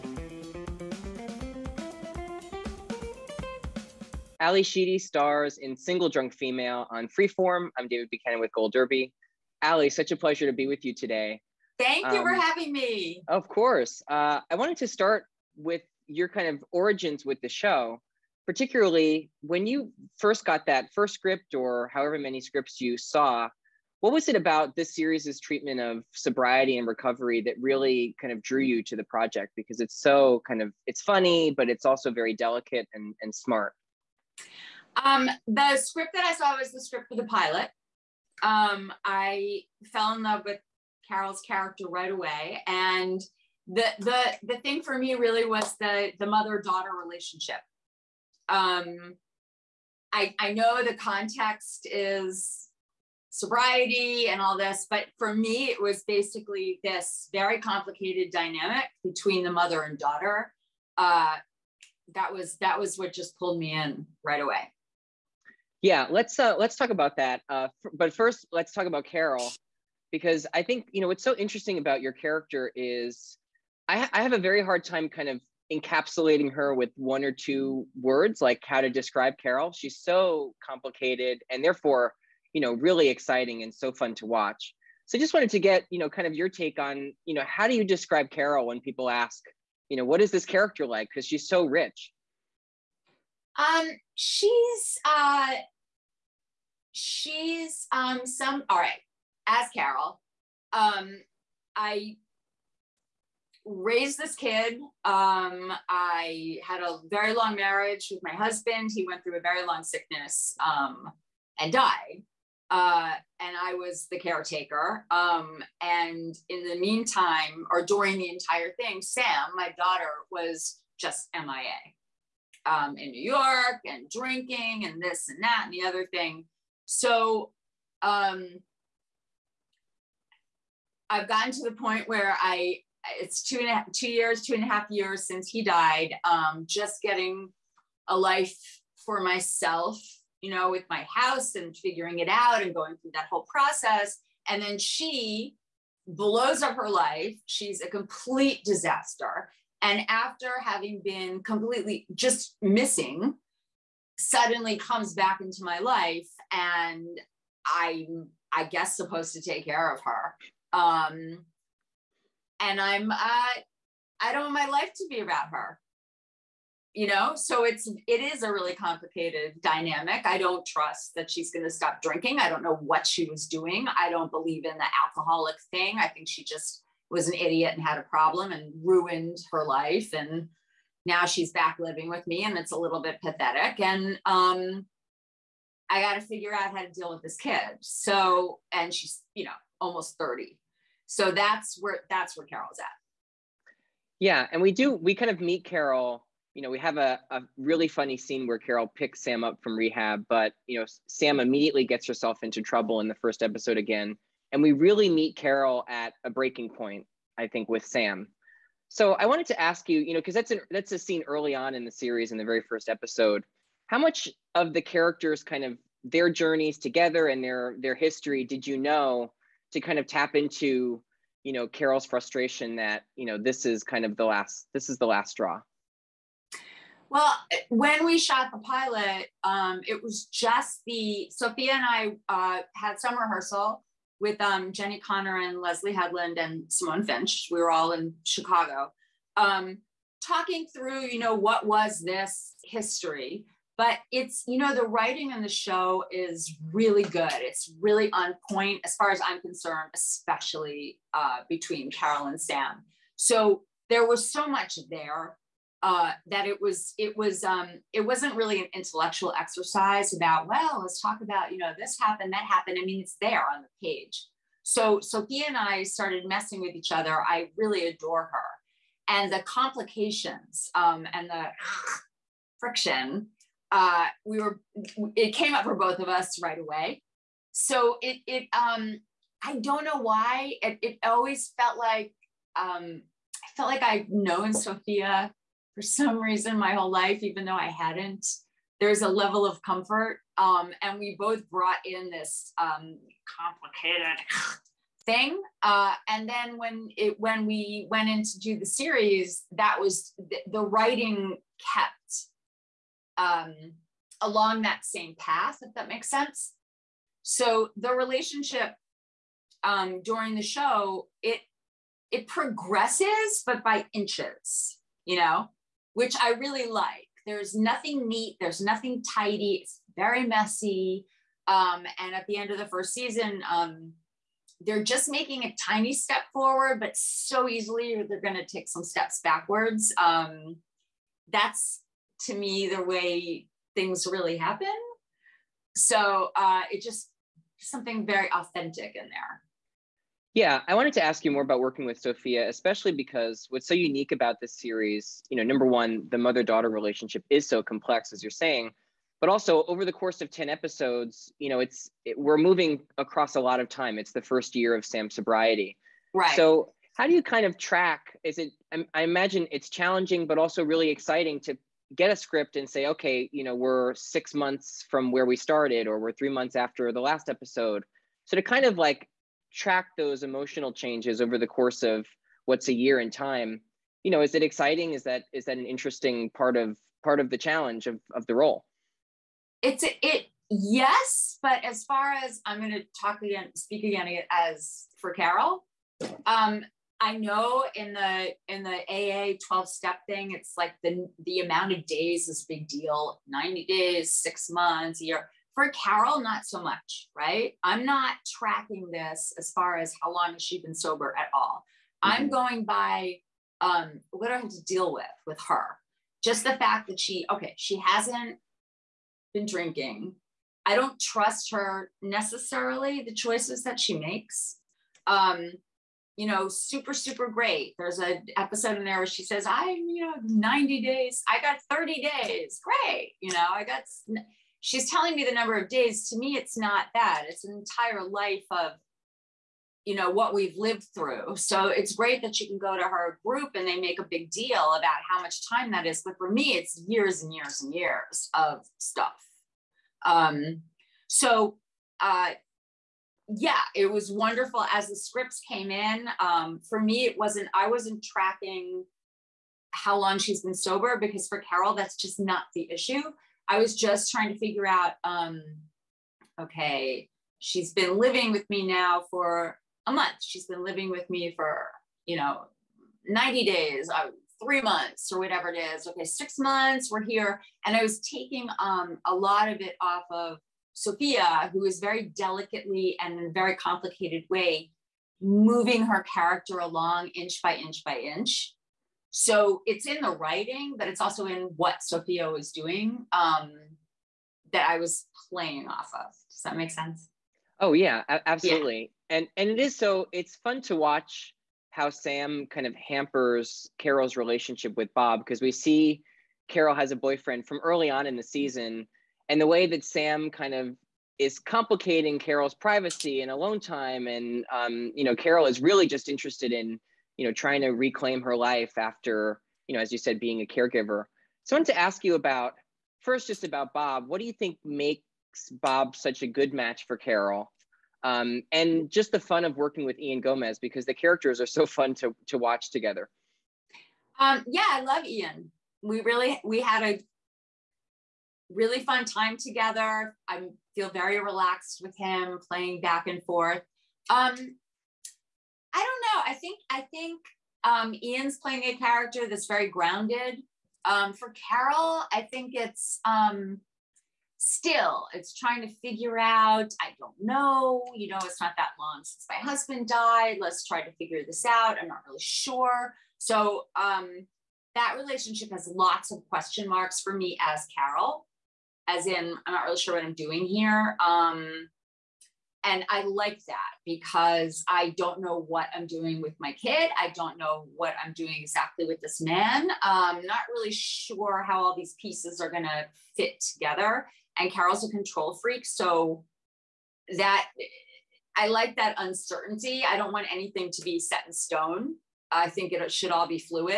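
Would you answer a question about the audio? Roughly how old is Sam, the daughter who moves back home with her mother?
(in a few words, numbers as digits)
almost 30.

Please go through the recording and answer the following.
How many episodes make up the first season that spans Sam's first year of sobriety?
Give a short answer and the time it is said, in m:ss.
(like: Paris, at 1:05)
10, at 5:50.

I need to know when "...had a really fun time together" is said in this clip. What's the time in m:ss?
8:46.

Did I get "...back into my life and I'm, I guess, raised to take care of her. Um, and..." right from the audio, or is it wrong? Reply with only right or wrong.
wrong.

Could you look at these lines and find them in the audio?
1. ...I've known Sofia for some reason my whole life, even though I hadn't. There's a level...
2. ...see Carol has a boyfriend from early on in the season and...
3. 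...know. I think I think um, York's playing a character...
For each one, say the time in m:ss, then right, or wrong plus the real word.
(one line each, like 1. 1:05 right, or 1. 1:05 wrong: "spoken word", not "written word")
1. 4:43 right
2. 8:15 right
3. 8:56 wrong: "Ian", not "York".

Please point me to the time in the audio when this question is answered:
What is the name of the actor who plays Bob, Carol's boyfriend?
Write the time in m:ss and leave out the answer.
8:39.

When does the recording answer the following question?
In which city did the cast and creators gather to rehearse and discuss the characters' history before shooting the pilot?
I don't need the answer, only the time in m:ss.
3:58.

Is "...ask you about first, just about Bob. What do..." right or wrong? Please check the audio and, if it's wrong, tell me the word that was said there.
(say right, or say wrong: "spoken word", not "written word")
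right.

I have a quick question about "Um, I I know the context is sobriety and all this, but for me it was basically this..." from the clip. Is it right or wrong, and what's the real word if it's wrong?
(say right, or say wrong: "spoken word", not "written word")
right.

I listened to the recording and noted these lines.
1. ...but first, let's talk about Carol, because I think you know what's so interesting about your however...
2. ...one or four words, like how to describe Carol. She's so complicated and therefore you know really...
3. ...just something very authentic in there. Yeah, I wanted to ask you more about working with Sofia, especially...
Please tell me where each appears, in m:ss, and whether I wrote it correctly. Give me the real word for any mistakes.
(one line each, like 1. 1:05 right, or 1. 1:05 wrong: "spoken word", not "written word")
1. 1:07 wrong: "character", not "however"
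2. 1:16 wrong: "two", not "four"
3. 5:36 right.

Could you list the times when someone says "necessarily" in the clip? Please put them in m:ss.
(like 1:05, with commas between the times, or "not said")
6:52.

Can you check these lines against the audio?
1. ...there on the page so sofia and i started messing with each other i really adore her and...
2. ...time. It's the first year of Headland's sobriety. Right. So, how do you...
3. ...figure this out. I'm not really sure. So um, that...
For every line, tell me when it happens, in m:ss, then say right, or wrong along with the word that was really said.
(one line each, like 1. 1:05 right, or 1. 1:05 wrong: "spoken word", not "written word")
1. 4:23 right
2. 5:53 wrong: "Sam", not "Headland"
3. 9:10 right.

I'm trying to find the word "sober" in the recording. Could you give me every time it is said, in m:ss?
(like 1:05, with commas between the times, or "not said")
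6:40, 7:30.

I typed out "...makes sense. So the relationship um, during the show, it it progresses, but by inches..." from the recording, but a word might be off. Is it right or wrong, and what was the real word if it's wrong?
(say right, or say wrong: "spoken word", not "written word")
right.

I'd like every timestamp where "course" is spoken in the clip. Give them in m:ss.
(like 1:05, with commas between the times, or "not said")
0:13, 5:49, 6:11.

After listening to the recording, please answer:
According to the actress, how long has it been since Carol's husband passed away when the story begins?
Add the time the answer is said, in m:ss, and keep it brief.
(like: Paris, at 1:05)
two and a half years, at 2:14.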